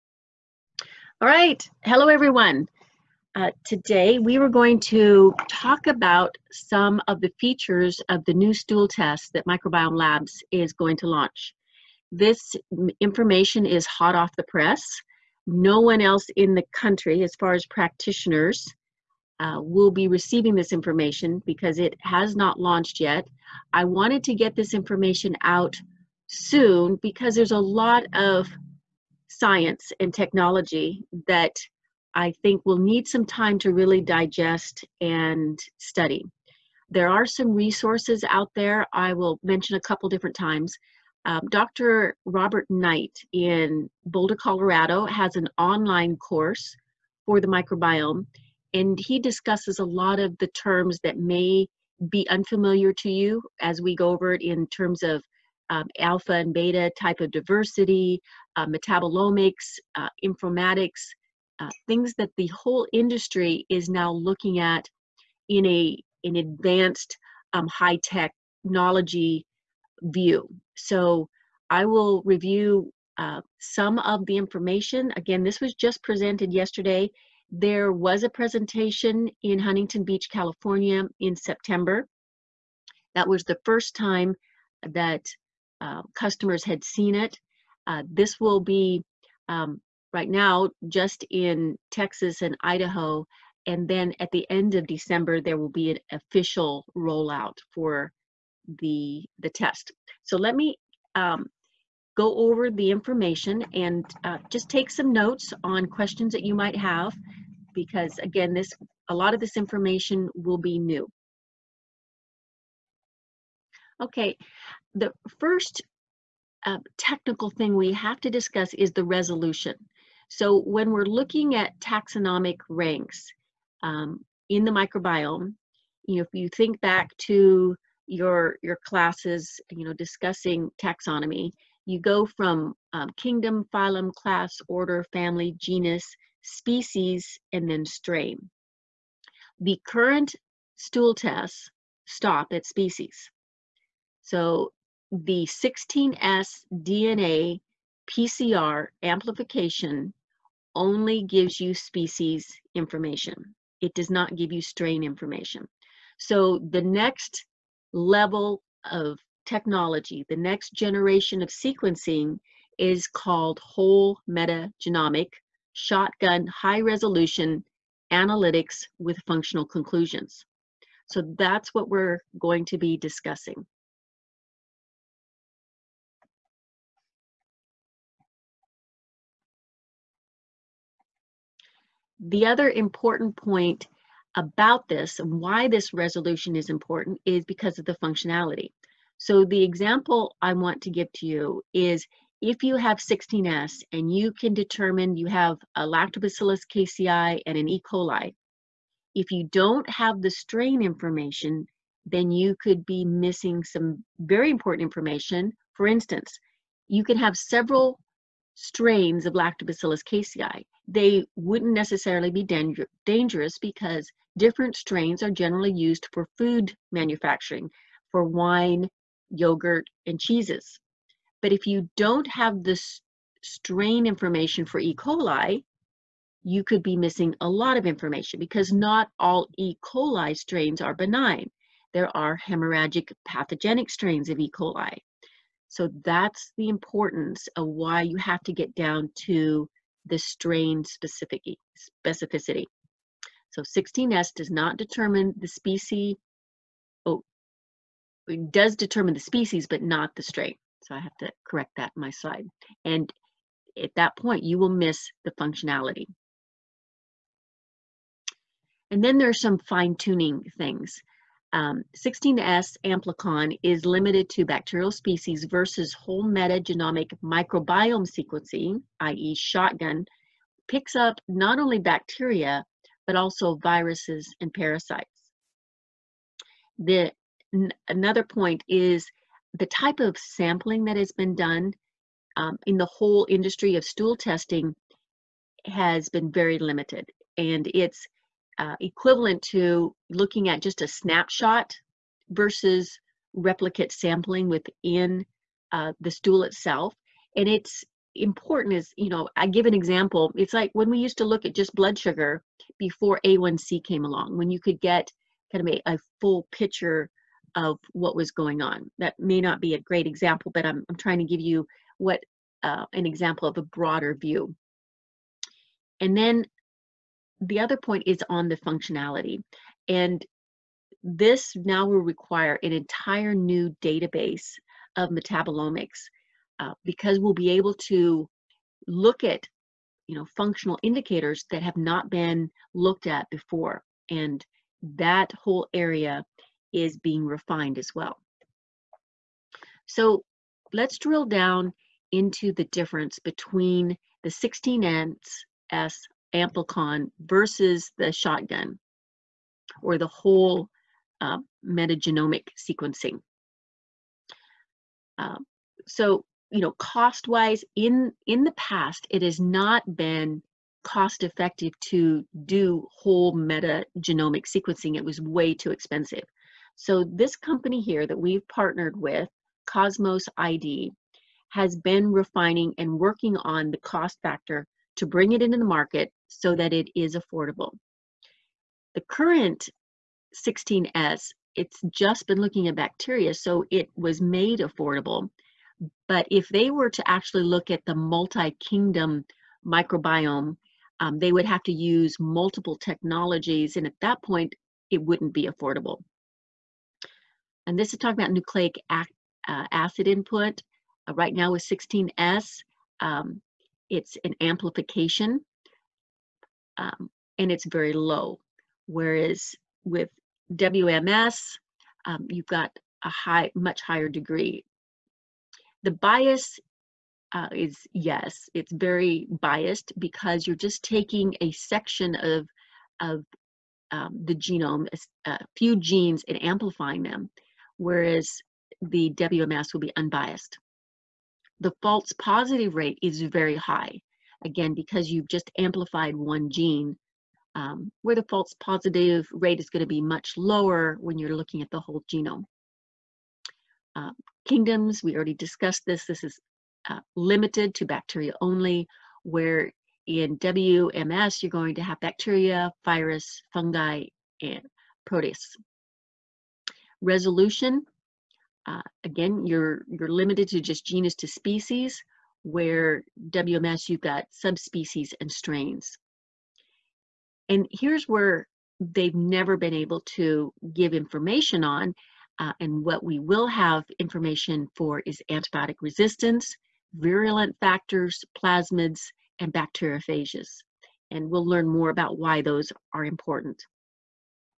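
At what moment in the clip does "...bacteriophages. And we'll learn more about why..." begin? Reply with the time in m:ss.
7:59.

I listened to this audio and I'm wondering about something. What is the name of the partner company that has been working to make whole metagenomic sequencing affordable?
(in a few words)
Cosmos ID.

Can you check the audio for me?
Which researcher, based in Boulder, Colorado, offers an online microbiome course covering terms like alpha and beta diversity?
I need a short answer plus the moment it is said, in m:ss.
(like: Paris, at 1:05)
Dr. Robert Knight, at 0:41.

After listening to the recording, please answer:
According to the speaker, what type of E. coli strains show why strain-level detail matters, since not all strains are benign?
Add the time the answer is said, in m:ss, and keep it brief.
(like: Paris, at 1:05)
Hemorrhagic pathogenic, at 3:52.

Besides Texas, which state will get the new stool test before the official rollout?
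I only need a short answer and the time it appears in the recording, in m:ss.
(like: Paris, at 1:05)
Idaho, at 1:32.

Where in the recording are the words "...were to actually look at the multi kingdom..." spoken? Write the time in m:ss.
6:26.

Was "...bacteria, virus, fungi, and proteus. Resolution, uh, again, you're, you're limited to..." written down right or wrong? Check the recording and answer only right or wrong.
right.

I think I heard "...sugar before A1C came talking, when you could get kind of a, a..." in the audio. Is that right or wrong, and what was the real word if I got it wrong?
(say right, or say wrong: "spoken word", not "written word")
wrong: "along", not "talking".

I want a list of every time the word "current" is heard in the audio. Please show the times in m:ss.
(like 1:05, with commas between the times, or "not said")
2:19, 6:19.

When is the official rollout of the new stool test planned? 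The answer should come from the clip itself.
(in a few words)
End of December.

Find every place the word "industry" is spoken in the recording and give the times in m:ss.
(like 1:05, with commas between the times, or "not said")
1:02, 4:43.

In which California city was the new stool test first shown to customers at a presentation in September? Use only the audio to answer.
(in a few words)
Huntington Beach.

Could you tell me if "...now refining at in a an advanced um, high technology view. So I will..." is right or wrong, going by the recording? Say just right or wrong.
wrong.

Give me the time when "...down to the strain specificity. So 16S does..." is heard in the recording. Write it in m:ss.
3:58.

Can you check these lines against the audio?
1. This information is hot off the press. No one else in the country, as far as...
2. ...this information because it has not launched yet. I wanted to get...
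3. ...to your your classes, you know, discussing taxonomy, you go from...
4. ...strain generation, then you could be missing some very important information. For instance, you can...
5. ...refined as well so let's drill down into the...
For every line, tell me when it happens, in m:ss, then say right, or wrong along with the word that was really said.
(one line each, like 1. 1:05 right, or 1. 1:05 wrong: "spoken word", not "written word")
1. 0:12 right
2. 0:20 right
3. 2:07 right
4. 3:20 wrong: "information", not "generation"
5. 5:37 right.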